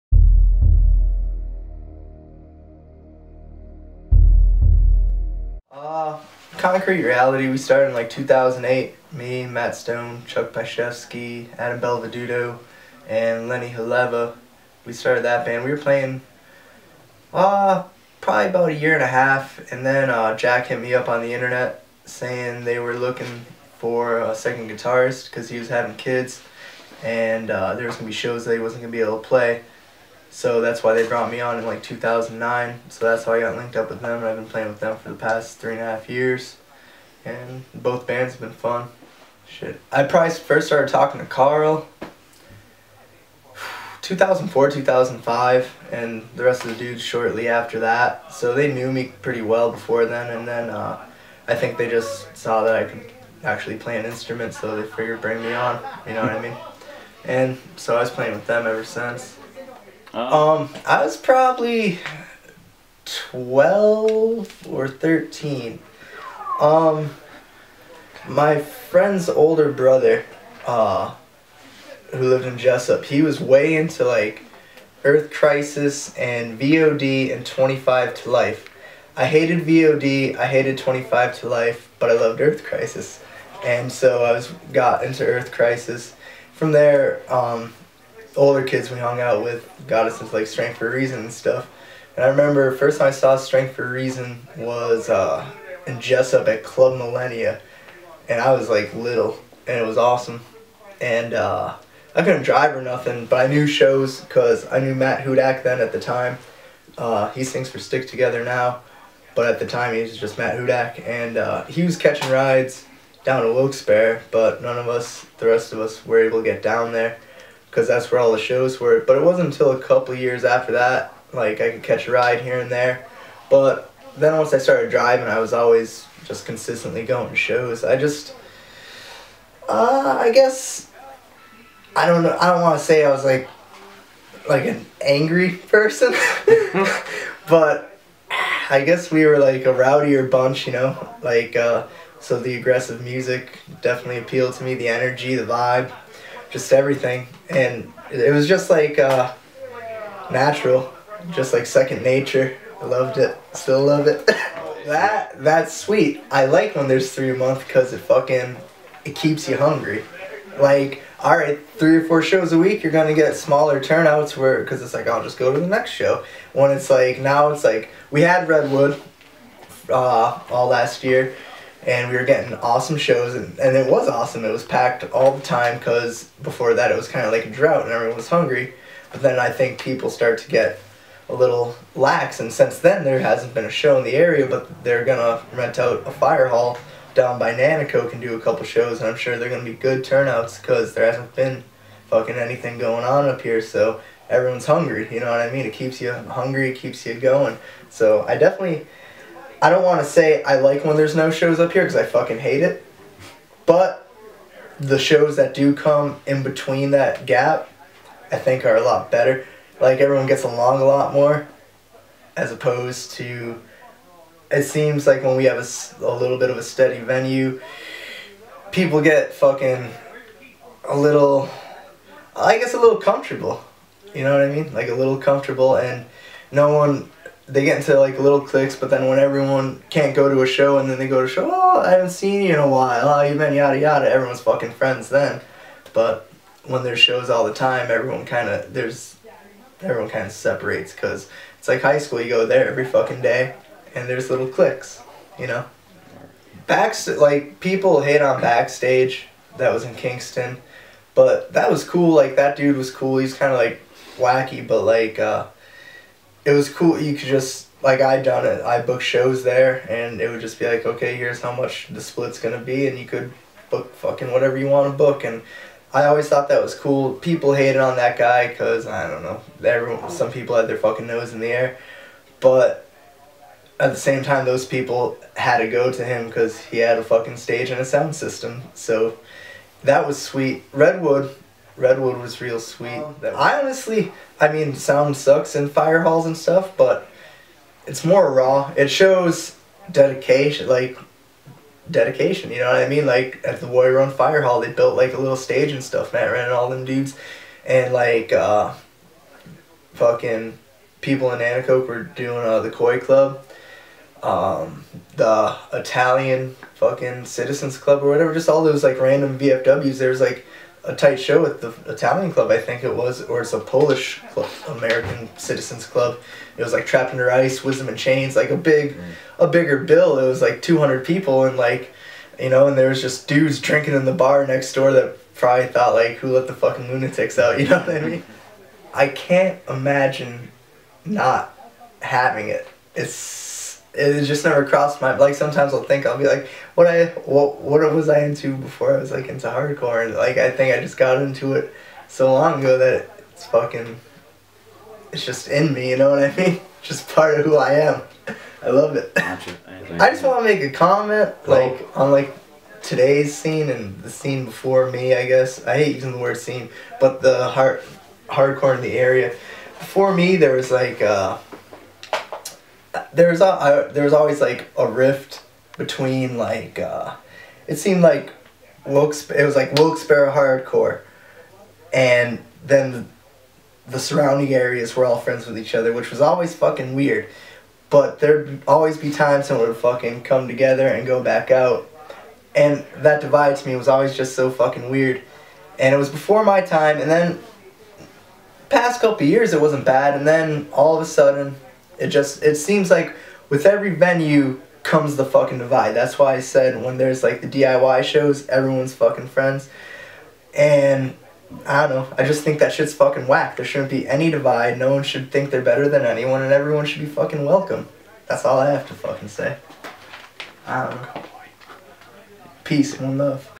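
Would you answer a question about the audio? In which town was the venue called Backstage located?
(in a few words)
Kingston.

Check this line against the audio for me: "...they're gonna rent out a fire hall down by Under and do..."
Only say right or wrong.
wrong.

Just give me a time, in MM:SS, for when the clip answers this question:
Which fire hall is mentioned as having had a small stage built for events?
04:53.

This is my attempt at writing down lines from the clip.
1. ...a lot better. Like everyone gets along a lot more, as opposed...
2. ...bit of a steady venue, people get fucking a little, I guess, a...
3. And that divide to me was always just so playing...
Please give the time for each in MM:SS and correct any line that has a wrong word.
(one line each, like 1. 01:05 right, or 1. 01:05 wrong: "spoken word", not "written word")
1. 03:28 right
2. 03:36 right
3. 06:22 wrong: "fucking", not "playing".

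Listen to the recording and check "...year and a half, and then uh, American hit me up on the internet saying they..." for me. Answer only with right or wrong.
wrong.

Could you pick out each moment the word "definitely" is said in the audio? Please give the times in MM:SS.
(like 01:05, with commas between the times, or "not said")
02:23, 03:18.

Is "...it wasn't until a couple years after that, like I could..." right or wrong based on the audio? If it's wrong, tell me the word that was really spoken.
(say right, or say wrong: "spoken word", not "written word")
right.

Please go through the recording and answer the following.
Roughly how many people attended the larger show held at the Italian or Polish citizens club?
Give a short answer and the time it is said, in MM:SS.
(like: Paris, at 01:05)
200, at 05:20.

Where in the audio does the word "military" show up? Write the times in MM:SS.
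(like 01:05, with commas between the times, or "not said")
not said.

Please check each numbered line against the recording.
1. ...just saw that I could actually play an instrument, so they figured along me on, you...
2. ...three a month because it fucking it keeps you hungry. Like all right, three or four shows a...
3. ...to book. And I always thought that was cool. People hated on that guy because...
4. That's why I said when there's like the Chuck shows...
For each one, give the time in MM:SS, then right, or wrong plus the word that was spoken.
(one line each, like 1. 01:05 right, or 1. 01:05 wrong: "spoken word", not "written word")
1. 00:51 wrong: "bring", not "along"
2. 02:37 right
3. 04:24 right
4. 06:35 wrong: "DIY", not "Chuck".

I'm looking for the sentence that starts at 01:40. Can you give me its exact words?
And uh, I couldn't drive or nothing, but I knew shows because I knew Matt Hudak then at the time.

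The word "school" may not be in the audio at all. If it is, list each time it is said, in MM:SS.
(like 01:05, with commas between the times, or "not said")
04:01.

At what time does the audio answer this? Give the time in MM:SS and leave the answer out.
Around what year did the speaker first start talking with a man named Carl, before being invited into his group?
00:44.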